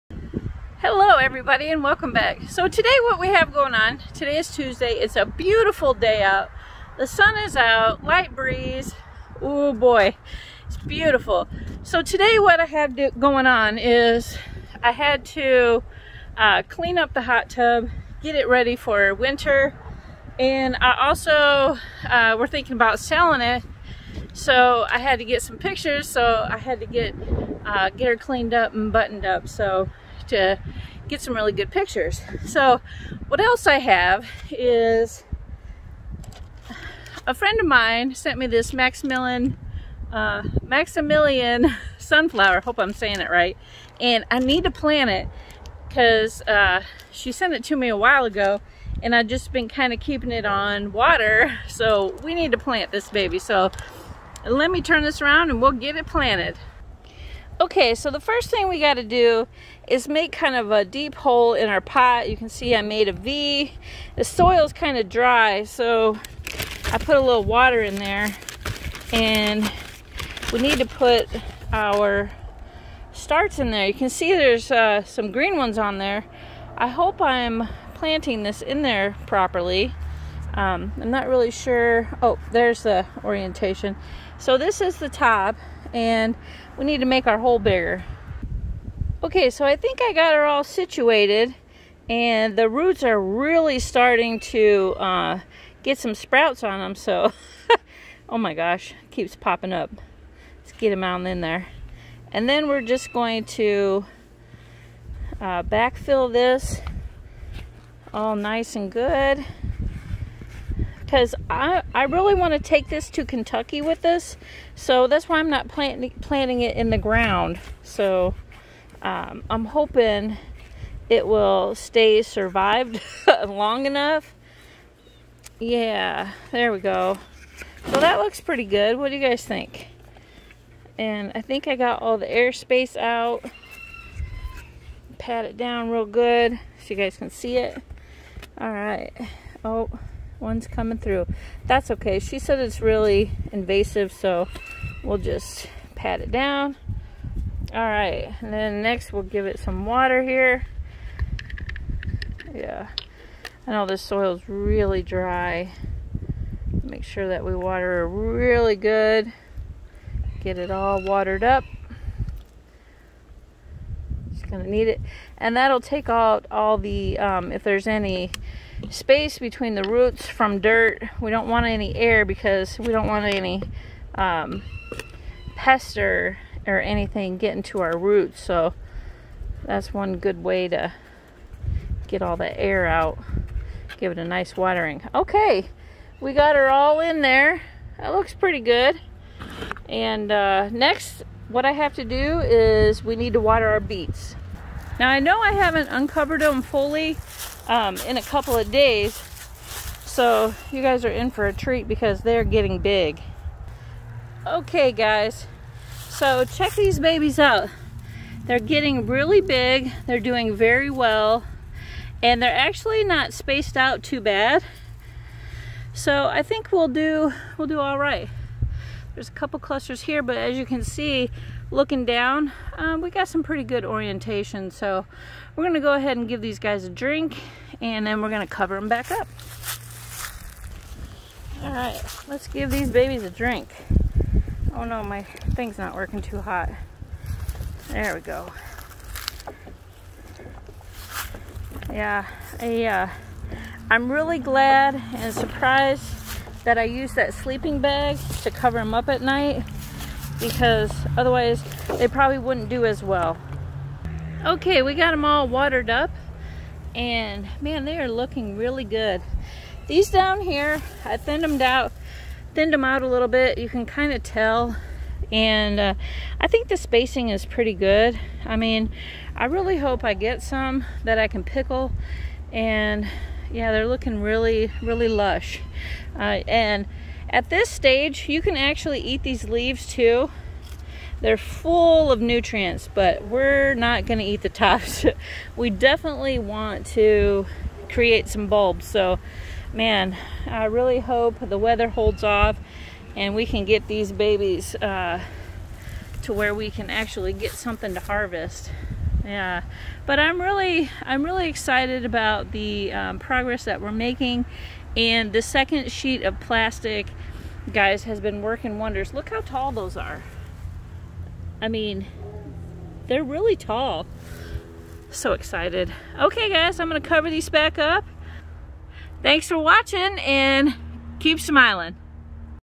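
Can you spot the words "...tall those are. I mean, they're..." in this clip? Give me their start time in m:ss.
5:09.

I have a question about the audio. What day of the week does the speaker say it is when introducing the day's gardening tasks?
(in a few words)
Tuesday.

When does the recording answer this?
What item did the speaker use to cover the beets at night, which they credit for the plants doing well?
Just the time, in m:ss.
4:07.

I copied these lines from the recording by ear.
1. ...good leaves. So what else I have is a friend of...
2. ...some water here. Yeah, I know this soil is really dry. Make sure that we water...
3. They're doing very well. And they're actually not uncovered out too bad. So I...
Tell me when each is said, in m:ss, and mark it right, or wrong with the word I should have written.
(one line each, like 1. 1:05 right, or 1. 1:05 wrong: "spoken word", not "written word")
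1. 0:31 wrong: "pictures", not "leaves"
2. 2:29 right
3. 3:30 wrong: "spaced", not "uncovered".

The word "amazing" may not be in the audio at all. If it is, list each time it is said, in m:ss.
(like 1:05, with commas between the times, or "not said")
not said.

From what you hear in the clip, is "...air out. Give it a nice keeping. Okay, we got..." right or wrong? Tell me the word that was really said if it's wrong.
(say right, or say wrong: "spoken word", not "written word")
wrong: "watering", not "keeping".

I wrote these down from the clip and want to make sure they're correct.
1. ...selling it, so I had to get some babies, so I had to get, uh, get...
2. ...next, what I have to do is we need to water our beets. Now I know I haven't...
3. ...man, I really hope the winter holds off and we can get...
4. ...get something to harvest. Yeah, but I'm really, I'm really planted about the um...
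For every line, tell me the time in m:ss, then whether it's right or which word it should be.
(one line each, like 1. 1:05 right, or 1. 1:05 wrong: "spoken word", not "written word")
1. 0:22 wrong: "pictures", not "babies"
2. 3:10 right
3. 4:49 wrong: "weather", not "winter"
4. 4:57 wrong: "excited", not "planted".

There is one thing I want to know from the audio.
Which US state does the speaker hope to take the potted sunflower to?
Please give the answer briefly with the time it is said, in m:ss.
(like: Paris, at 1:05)
Kentucky, at 1:53.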